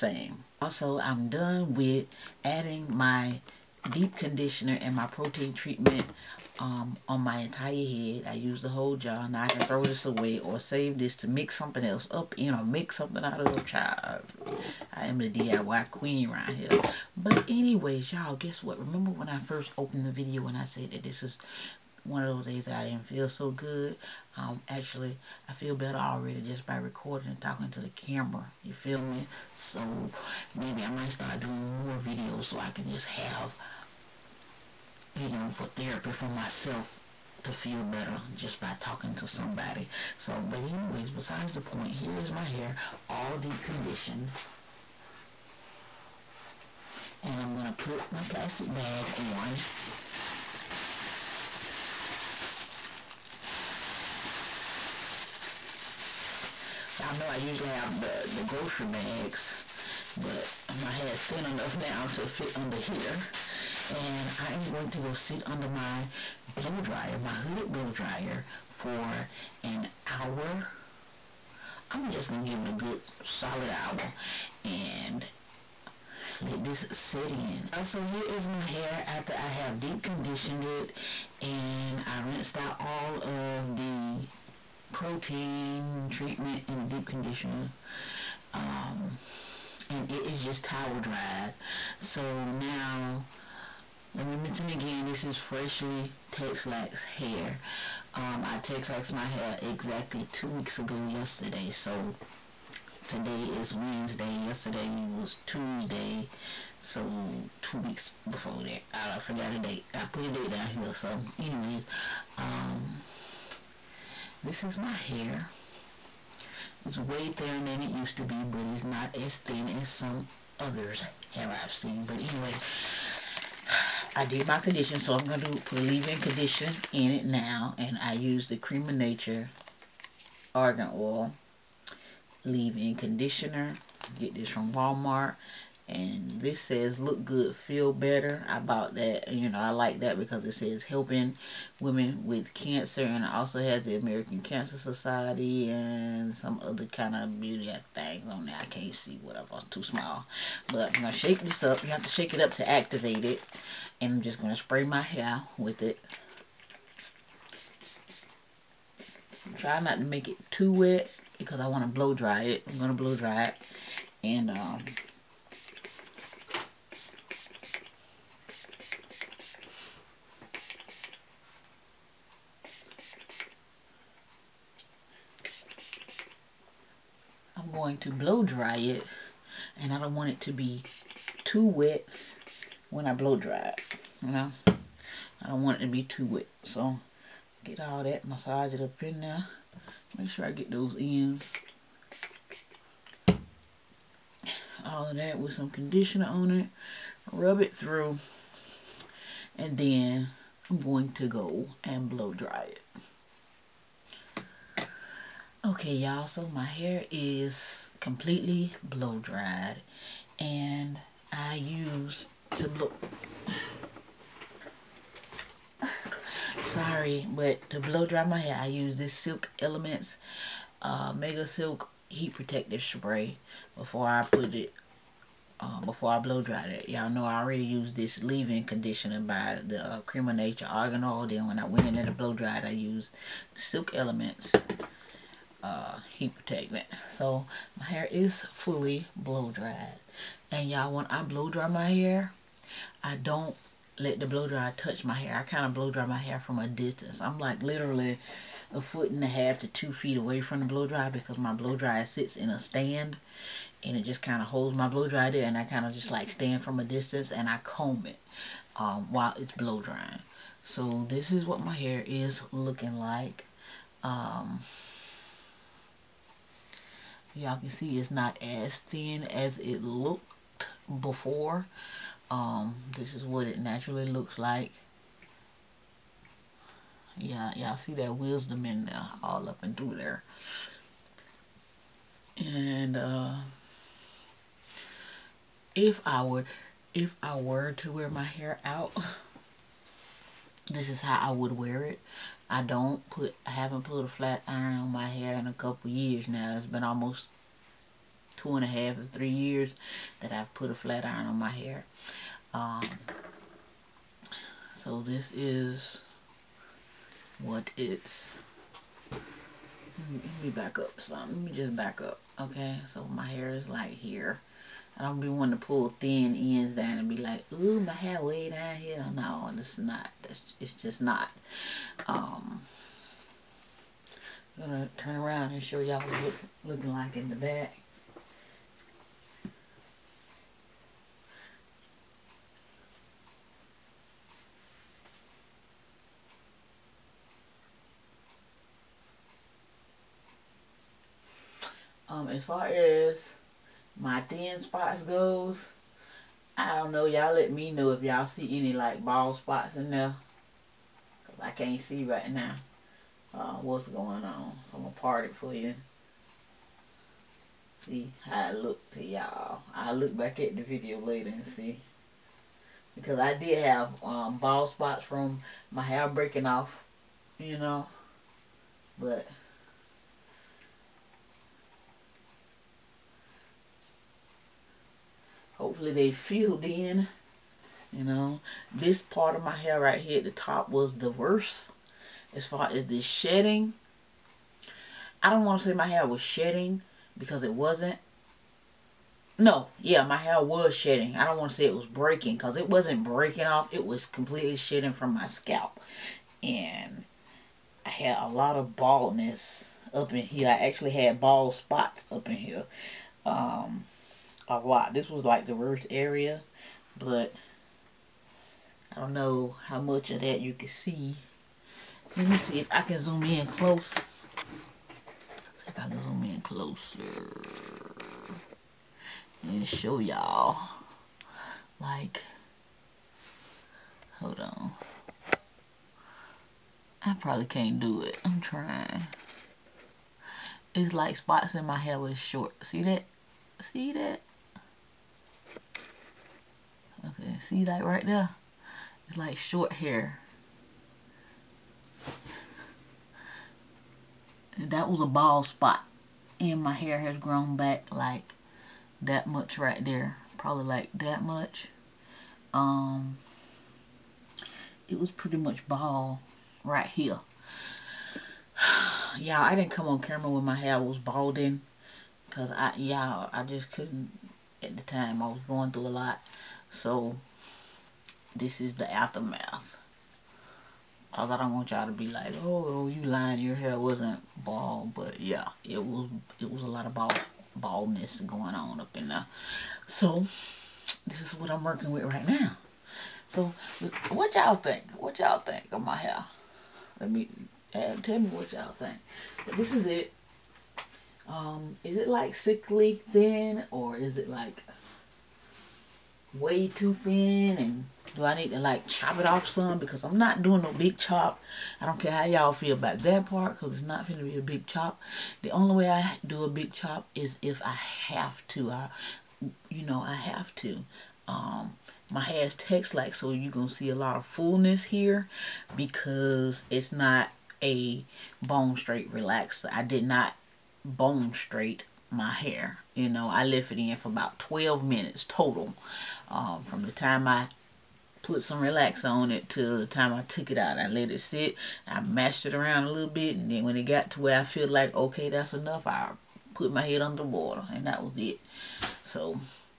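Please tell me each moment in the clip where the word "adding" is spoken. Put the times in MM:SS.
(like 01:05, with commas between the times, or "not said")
00:02.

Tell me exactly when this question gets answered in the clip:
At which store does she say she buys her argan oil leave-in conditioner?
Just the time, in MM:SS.
02:14.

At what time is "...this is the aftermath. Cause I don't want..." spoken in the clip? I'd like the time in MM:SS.
07:48.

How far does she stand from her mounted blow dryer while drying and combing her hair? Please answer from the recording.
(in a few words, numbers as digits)
a foot and a half to two feet.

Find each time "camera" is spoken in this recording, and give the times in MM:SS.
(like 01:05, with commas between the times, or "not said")
00:27, 07:39.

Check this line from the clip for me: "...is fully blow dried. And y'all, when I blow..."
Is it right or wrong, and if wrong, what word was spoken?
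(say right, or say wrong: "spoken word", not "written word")
right.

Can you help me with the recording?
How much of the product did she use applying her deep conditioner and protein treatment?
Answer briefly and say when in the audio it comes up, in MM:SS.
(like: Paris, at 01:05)
the whole jar, at 00:08.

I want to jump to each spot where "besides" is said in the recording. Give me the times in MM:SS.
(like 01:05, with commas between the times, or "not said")
00:41.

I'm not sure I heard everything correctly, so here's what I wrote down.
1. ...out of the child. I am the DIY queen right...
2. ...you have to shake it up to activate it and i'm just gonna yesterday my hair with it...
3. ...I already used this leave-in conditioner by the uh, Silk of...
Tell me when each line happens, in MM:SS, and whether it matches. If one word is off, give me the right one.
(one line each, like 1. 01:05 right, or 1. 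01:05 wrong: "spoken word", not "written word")
1. 00:13 right
2. 02:31 wrong: "spray", not "yesterday"
3. 03:47 wrong: "Cream", not "Silk".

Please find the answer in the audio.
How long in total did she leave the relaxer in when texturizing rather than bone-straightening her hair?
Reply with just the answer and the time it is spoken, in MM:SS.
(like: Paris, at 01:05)
12 minutes, at 08:44.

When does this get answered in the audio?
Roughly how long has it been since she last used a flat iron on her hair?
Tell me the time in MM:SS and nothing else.
04:58.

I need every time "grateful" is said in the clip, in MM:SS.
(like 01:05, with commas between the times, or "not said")
not said.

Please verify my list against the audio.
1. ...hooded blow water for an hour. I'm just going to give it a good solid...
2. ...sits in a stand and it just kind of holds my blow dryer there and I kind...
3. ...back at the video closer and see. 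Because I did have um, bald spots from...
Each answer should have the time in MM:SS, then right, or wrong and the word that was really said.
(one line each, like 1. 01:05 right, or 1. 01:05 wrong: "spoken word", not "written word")
1. 01:07 wrong: "dryer", not "water"
2. 04:12 right
3. 06:00 wrong: "later", not "closer".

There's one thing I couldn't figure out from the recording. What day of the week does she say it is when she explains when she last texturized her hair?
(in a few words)
Wednesday.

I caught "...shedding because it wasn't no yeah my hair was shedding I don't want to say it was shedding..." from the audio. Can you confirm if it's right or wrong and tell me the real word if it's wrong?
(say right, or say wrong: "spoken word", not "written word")
wrong: "breaking", not "shedding".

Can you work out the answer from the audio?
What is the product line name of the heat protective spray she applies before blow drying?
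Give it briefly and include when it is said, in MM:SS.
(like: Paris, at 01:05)
Mega Silk, at 03:41.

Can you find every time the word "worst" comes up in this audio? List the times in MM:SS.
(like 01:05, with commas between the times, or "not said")
06:21, 06:45.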